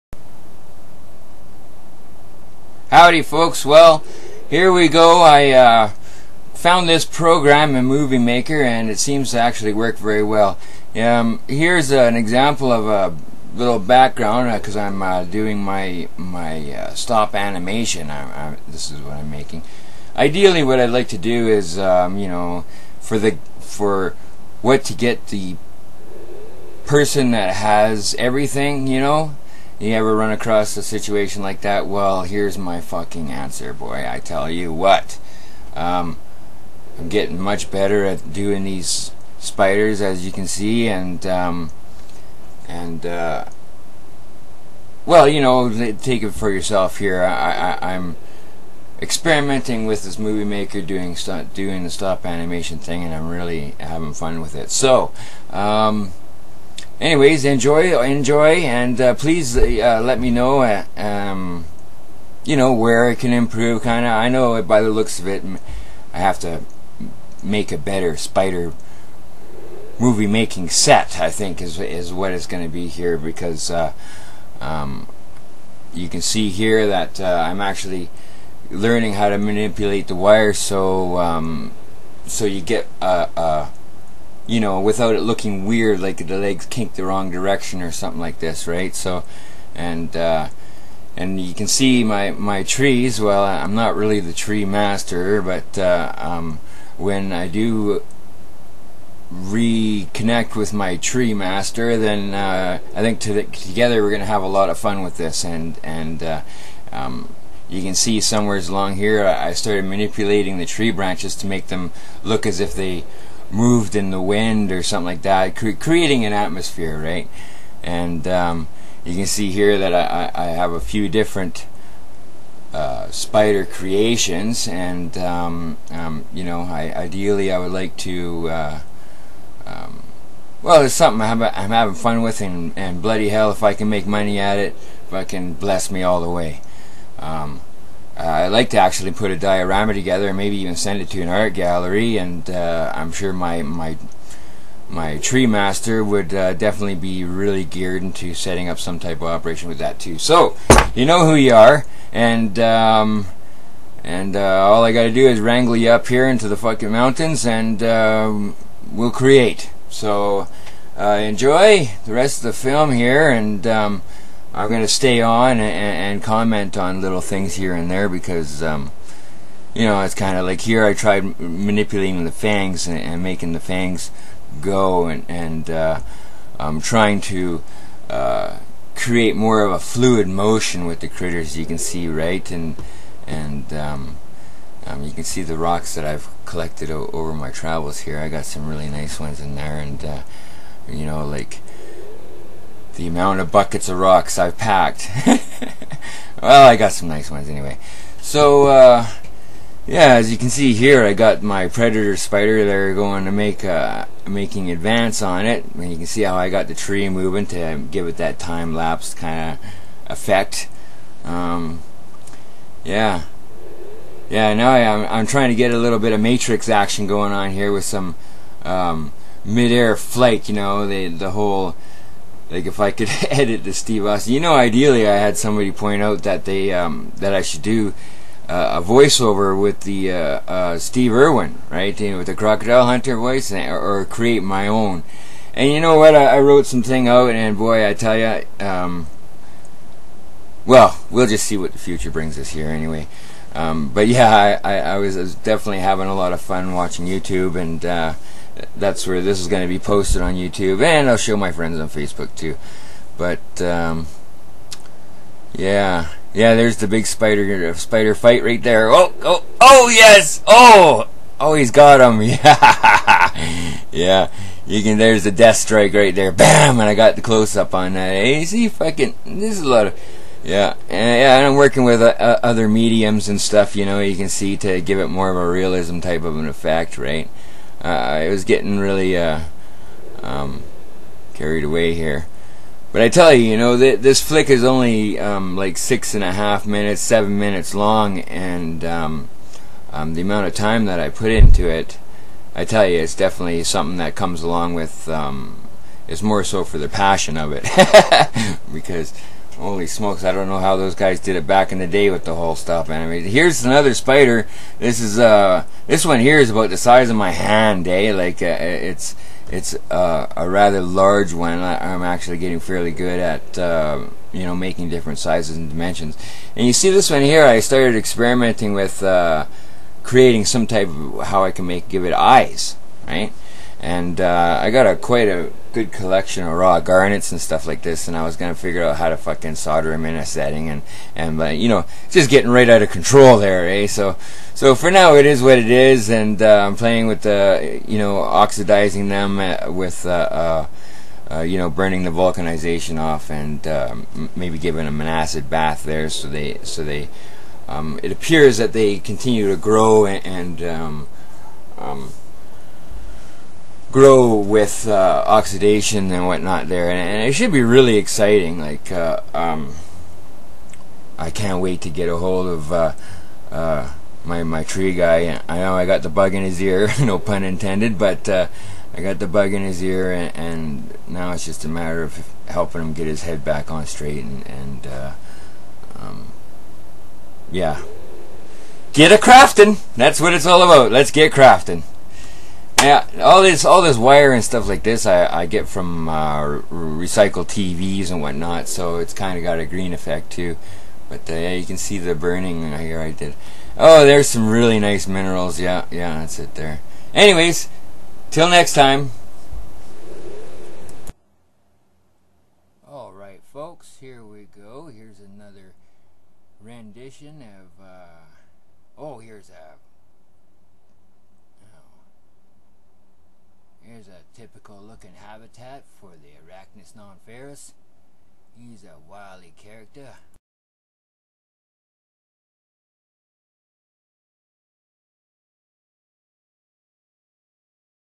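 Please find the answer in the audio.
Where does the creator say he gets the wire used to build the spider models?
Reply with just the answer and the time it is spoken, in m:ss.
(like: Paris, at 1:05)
recycled TVs, at 6:26.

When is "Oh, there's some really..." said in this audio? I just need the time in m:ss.
6:33.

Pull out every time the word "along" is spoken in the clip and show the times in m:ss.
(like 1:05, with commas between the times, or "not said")
1:48, 4:54.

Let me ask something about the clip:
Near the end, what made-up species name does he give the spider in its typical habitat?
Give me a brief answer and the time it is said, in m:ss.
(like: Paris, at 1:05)
Arachnus nonferus, at 6:56.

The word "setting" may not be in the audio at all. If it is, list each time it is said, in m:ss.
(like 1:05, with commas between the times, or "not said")
2:28, 5:30.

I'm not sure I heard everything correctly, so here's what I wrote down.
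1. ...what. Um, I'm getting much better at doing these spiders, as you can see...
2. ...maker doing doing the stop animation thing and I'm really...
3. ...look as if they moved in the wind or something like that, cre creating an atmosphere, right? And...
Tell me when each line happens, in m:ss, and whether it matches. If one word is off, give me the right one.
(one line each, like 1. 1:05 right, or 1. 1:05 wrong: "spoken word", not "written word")
1. 0:34 right
2. 0:50 right
3. 1:52 right.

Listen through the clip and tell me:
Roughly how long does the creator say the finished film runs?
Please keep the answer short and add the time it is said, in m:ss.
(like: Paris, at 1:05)
six and a half minutes, at 4:45.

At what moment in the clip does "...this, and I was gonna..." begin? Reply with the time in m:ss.
5:27.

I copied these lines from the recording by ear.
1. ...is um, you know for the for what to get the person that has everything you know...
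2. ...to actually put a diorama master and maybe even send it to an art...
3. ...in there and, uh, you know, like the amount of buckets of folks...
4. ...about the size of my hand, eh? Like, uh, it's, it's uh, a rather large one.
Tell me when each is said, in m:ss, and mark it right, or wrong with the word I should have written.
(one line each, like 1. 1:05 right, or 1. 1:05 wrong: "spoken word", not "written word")
1. 0:21 right
2. 2:18 wrong: "together", not "master"
3. 3:09 wrong: "rocks", not "folks"
4. 5:06 right.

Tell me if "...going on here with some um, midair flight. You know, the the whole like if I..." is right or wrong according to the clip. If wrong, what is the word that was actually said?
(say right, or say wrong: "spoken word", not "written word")
right.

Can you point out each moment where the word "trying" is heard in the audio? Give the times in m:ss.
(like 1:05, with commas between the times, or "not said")
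2:56, 3:35.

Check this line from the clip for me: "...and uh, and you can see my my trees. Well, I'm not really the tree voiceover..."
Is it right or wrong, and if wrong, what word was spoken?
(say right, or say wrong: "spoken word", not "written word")
wrong: "master", not "voiceover".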